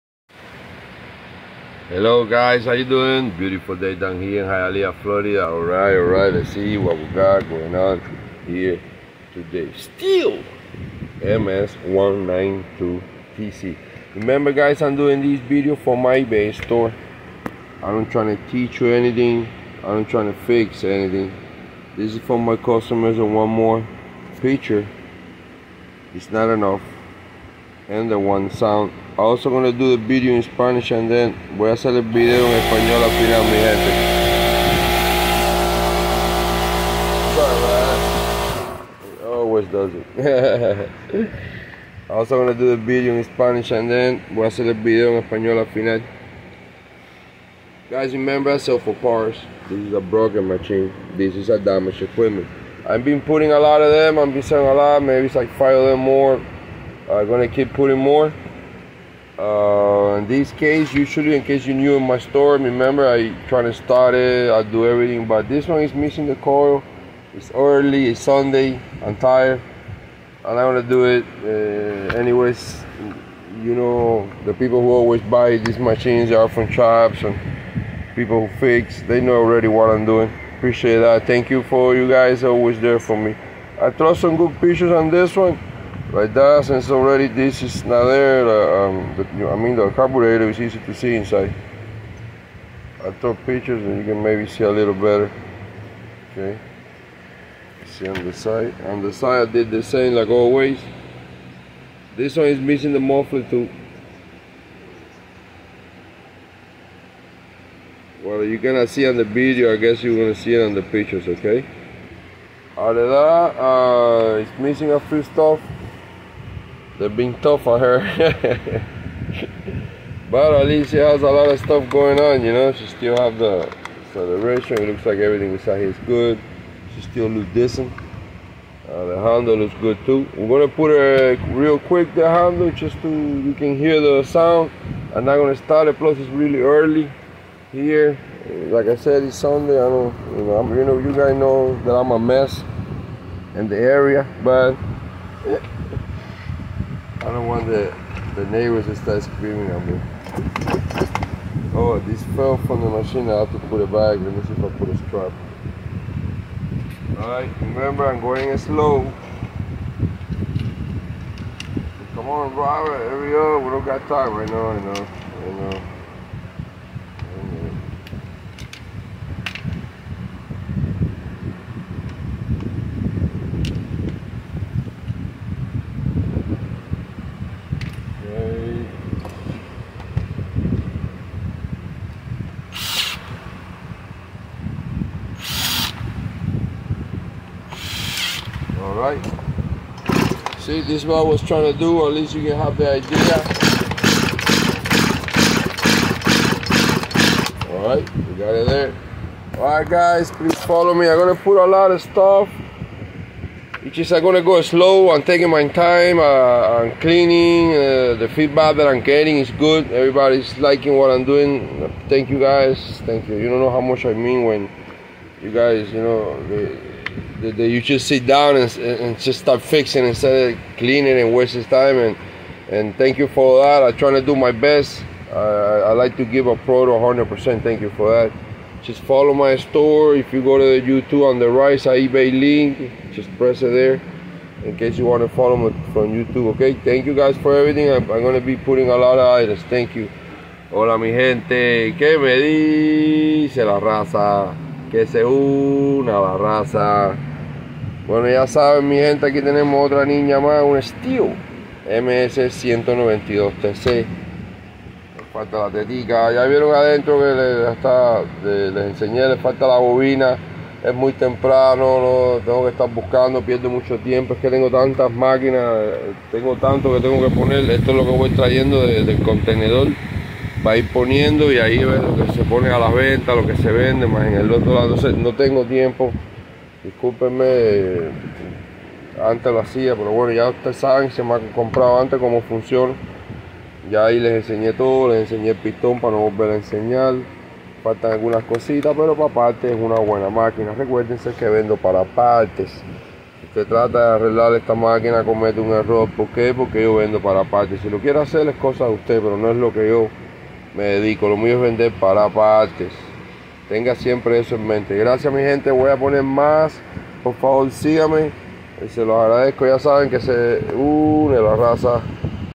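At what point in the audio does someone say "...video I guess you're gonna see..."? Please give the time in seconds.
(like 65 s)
109 s.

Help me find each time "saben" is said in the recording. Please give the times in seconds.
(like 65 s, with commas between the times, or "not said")
248 s, 280 s, 309 s.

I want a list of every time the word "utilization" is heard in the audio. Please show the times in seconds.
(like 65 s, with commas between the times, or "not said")
not said.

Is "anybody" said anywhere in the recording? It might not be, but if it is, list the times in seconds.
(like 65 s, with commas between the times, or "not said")
not said.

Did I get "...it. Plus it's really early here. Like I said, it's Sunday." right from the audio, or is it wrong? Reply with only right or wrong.
right.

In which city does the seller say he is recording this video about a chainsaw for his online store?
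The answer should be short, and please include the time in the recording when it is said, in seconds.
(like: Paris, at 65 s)
Hialeah, Florida, at 4 s.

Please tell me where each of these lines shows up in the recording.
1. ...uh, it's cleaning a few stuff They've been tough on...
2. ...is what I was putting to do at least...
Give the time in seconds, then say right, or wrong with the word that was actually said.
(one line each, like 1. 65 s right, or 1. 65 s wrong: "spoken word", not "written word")
1. 113 s wrong: "missing", not "cleaning"
2. 191 s wrong: "trying", not "putting".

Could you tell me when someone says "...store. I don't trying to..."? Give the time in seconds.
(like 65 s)
16 s.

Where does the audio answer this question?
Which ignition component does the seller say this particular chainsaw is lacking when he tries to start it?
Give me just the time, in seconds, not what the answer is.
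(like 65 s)
66 s.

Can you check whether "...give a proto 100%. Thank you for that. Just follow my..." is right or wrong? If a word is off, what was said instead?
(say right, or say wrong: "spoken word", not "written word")
right.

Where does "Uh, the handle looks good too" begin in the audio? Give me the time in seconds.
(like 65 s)
128 s.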